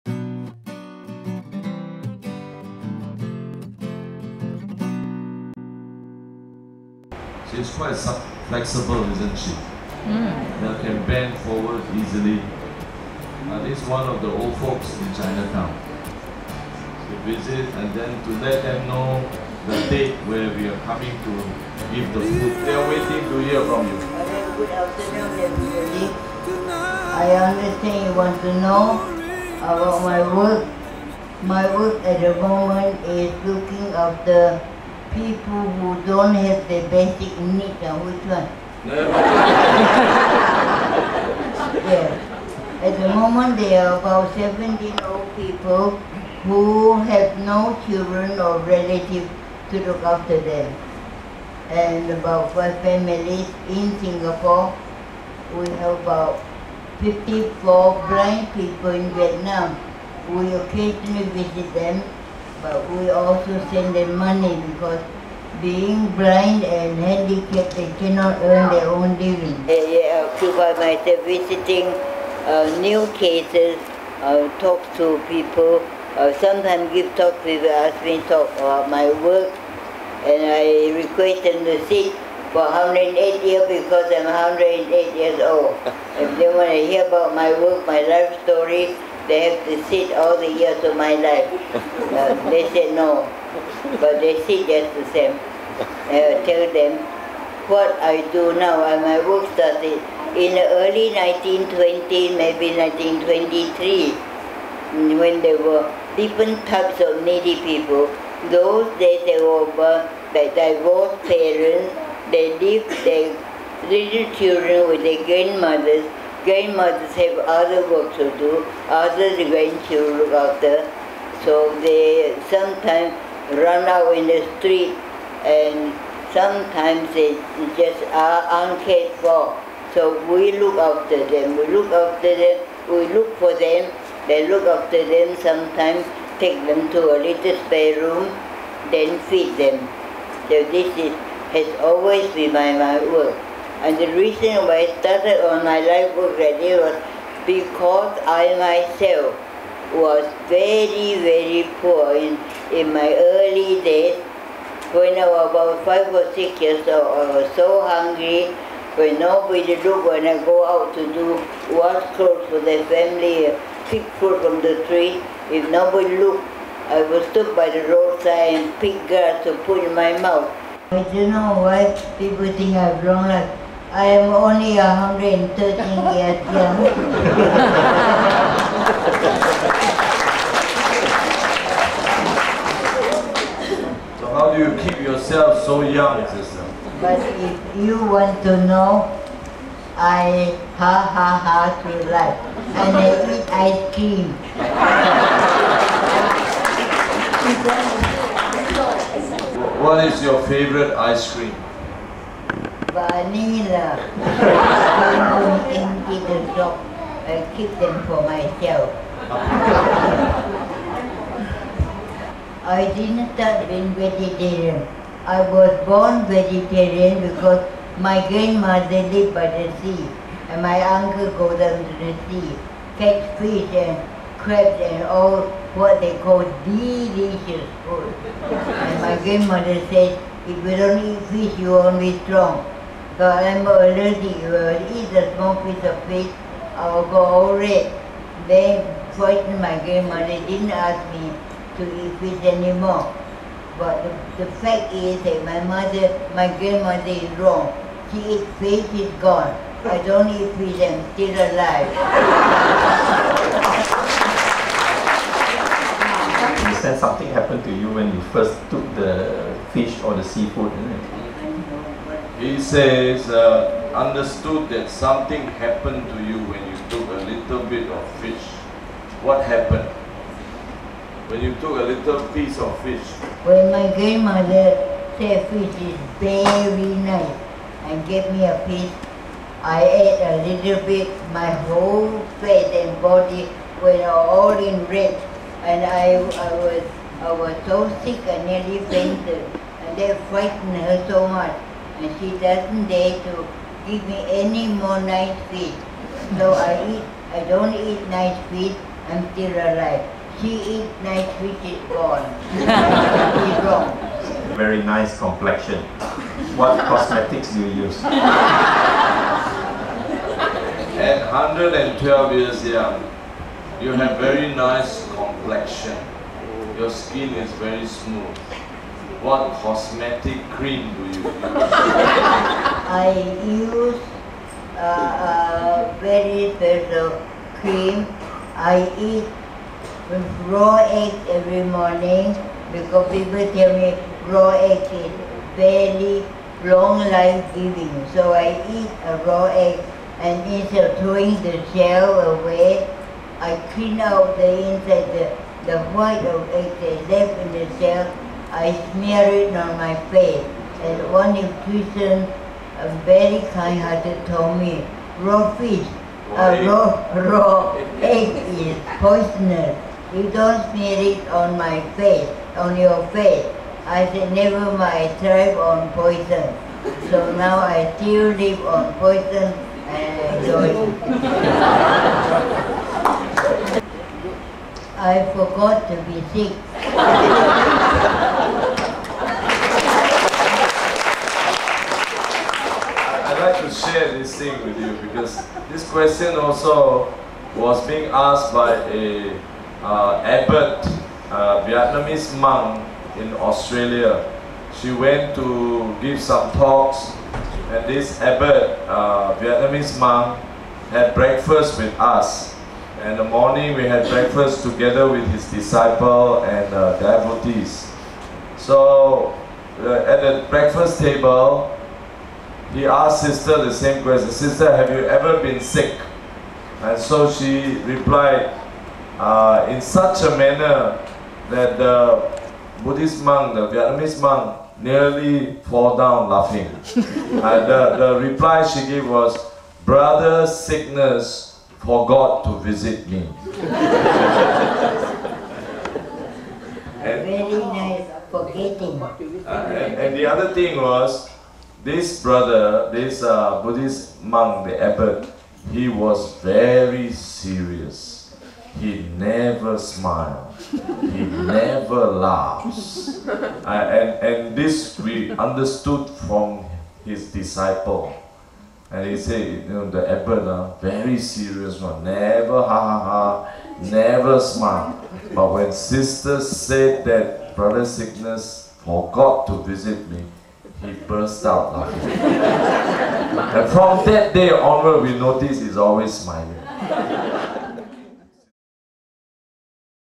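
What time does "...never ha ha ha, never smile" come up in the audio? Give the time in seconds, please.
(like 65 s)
462 s.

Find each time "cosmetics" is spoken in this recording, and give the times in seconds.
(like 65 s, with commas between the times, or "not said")
306 s, 319 s.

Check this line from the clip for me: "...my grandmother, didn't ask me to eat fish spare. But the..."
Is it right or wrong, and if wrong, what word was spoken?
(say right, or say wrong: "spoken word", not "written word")
wrong: "anymore", not "spare".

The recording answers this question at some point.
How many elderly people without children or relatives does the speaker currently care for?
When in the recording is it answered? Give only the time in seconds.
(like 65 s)
44 s.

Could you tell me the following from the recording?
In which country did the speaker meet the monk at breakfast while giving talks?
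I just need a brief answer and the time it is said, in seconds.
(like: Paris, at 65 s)
Australia, at 393 s.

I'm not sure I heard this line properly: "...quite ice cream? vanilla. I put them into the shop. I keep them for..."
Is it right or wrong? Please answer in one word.
wrong.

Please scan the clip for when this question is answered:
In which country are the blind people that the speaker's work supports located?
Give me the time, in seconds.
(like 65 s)
59 s.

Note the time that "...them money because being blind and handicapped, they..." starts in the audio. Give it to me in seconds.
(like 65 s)
63 s.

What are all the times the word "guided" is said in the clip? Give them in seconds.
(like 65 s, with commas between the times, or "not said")
not said.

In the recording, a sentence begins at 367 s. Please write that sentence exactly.
So now I still live on poison and enjoy it.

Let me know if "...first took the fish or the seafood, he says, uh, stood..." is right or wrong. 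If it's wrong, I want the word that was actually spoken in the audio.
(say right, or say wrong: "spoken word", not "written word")
wrong: "understood", not "stood".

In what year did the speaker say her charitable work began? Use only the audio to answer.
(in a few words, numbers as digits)
1923.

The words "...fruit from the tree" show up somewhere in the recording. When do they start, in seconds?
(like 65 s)
164 s.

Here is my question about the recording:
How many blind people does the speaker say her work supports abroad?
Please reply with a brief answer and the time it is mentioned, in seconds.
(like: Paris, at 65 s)
54, at 57 s.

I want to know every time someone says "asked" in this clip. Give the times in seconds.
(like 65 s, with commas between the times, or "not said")
388 s, 412 s.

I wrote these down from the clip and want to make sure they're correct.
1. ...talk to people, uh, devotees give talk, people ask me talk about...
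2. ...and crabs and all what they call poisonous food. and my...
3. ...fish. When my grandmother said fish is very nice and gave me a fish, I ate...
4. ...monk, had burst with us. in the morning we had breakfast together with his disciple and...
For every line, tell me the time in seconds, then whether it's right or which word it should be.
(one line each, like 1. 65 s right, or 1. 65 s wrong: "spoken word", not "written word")
1. 74 s wrong: "sometimes", not "devotees"
2. 223 s wrong: "delicious", not "poisonous"
3. 272 s right
4. 399 s wrong: "breakfast", not "burst".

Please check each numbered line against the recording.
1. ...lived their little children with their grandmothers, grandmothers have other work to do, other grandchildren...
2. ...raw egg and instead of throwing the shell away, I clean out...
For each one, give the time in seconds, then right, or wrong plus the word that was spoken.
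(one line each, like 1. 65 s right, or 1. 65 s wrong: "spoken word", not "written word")
1. 112 s right
2. 339 s right.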